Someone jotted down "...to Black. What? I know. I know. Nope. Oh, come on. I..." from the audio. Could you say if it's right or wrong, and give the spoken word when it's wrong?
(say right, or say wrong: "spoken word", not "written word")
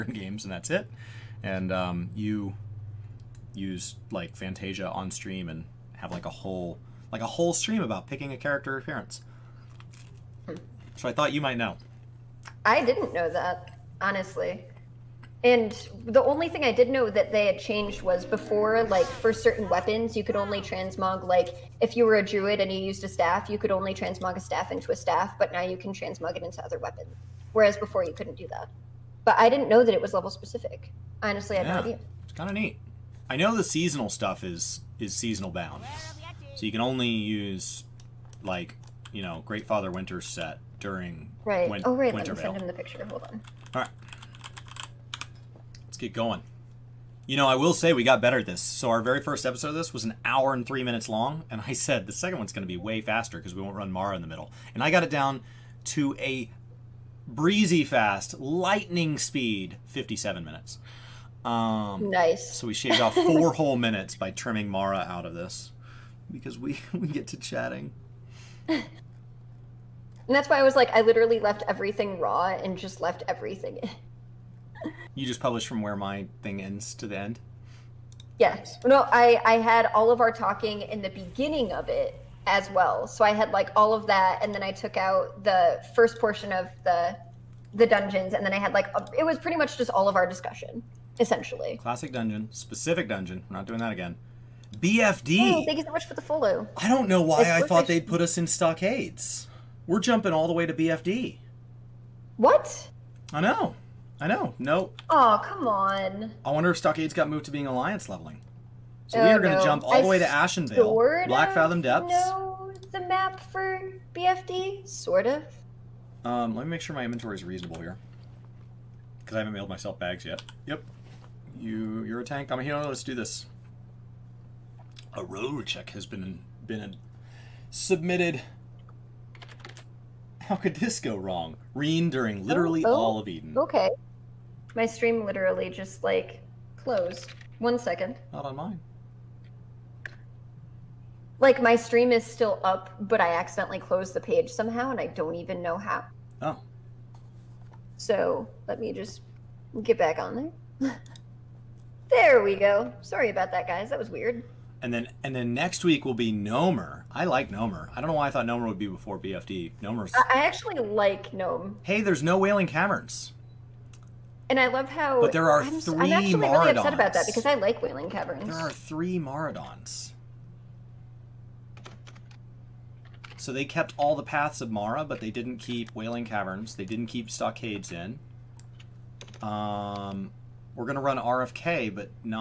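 wrong: "BFD", not "Black".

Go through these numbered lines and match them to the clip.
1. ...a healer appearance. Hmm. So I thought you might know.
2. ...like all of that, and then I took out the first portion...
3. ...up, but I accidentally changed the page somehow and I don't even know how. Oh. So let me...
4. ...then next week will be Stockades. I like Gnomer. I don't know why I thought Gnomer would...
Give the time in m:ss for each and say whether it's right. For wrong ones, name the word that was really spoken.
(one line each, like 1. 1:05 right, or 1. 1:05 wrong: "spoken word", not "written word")
1. 0:08 wrong: "character", not "healer"
2. 1:23 right
3. 2:22 wrong: "closed", not "changed"
4. 2:35 wrong: "Gnomer", not "Stockades".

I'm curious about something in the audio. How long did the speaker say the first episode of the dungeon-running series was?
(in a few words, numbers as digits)
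1 hour 3 minutes.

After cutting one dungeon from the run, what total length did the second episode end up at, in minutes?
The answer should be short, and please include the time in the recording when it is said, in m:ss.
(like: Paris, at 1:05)
57, at 0:59.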